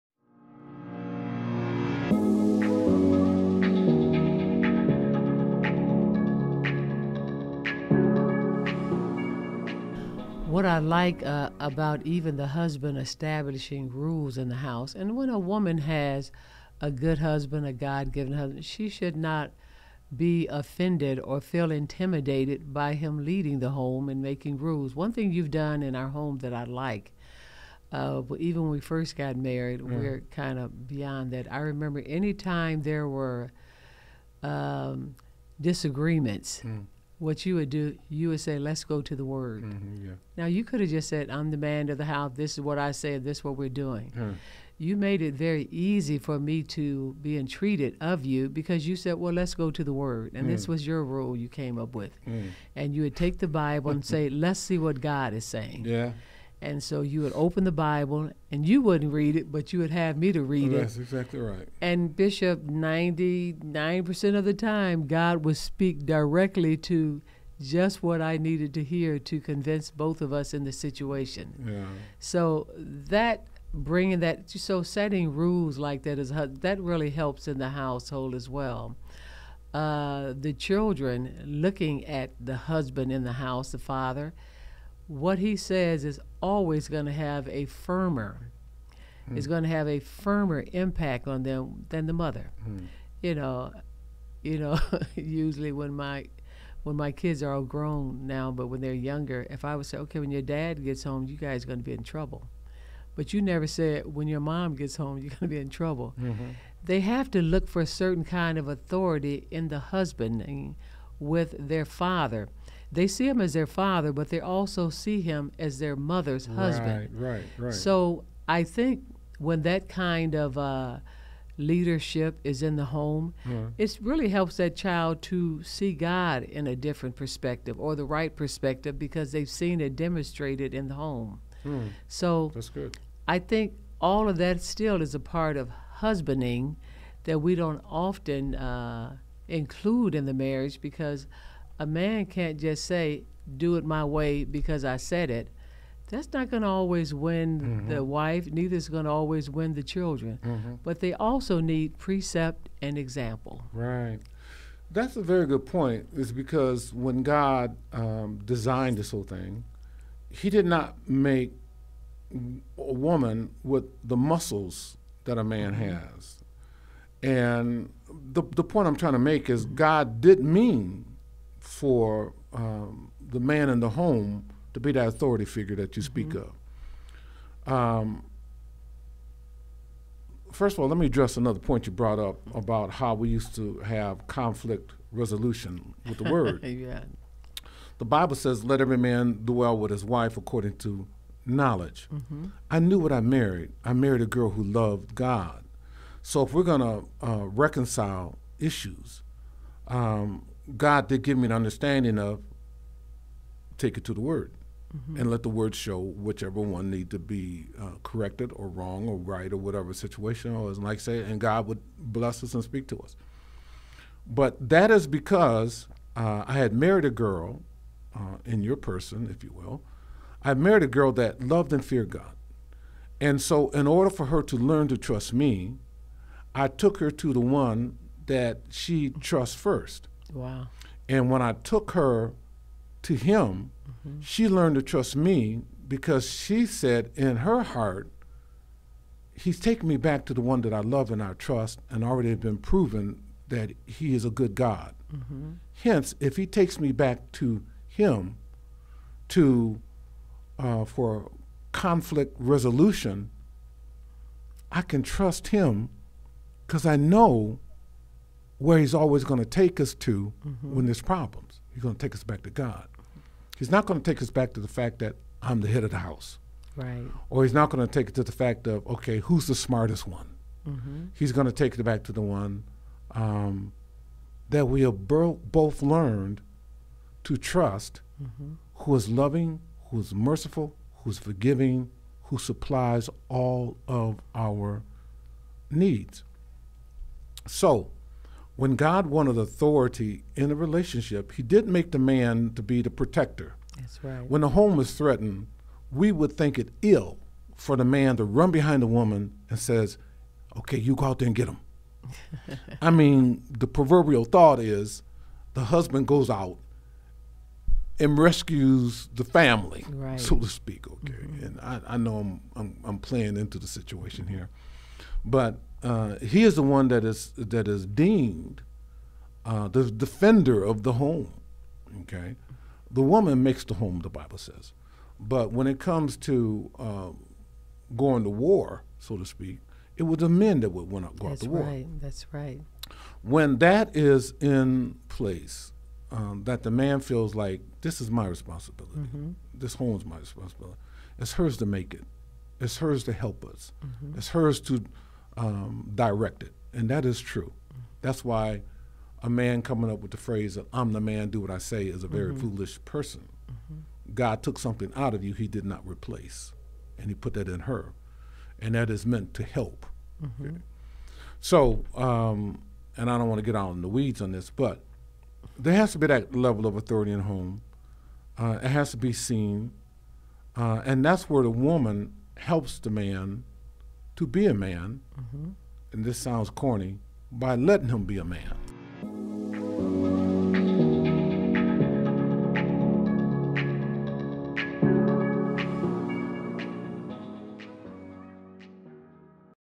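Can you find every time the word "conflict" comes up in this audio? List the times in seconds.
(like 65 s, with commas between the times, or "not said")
184 s, 251 s.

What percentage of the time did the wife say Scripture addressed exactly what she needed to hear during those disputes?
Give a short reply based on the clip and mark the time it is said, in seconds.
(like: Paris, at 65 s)
99%, at 62 s.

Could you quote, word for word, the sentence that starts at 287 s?
So, when God wanted authority in a relationship, He did not make the man to be the protector.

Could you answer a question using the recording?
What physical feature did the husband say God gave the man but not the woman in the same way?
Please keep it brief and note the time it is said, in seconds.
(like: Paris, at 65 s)
muscles, at 164 s.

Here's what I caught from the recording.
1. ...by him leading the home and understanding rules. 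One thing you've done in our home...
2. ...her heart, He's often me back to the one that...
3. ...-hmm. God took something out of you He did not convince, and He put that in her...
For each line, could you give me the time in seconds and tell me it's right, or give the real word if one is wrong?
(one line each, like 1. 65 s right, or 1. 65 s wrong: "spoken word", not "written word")
1. 22 s wrong: "making", not "understanding"
2. 237 s wrong: "taken", not "often"
3. 353 s wrong: "replace", not "convince".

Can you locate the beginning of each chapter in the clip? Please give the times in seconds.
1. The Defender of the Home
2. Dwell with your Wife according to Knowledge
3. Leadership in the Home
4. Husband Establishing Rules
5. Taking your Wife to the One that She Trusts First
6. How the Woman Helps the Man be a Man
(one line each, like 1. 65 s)
1. 316 s
2. 154 s
3. 80 s
4. 10 s
5. 214 s
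6. 360 s.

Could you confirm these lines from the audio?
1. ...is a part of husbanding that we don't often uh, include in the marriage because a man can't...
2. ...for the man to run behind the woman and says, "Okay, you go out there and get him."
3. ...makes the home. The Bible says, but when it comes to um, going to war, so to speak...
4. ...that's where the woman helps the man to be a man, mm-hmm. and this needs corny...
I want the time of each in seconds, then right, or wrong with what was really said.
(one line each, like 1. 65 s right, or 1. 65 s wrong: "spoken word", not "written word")
1. 135 s right
2. 297 s right
3. 323 s right
4. 371 s wrong: "sounds", not "needs".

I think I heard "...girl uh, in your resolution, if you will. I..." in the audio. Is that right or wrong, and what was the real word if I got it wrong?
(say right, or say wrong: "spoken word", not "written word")
wrong: "person", not "resolution".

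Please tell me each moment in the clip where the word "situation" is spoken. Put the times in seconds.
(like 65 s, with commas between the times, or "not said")
70 s, 209 s, 313 s.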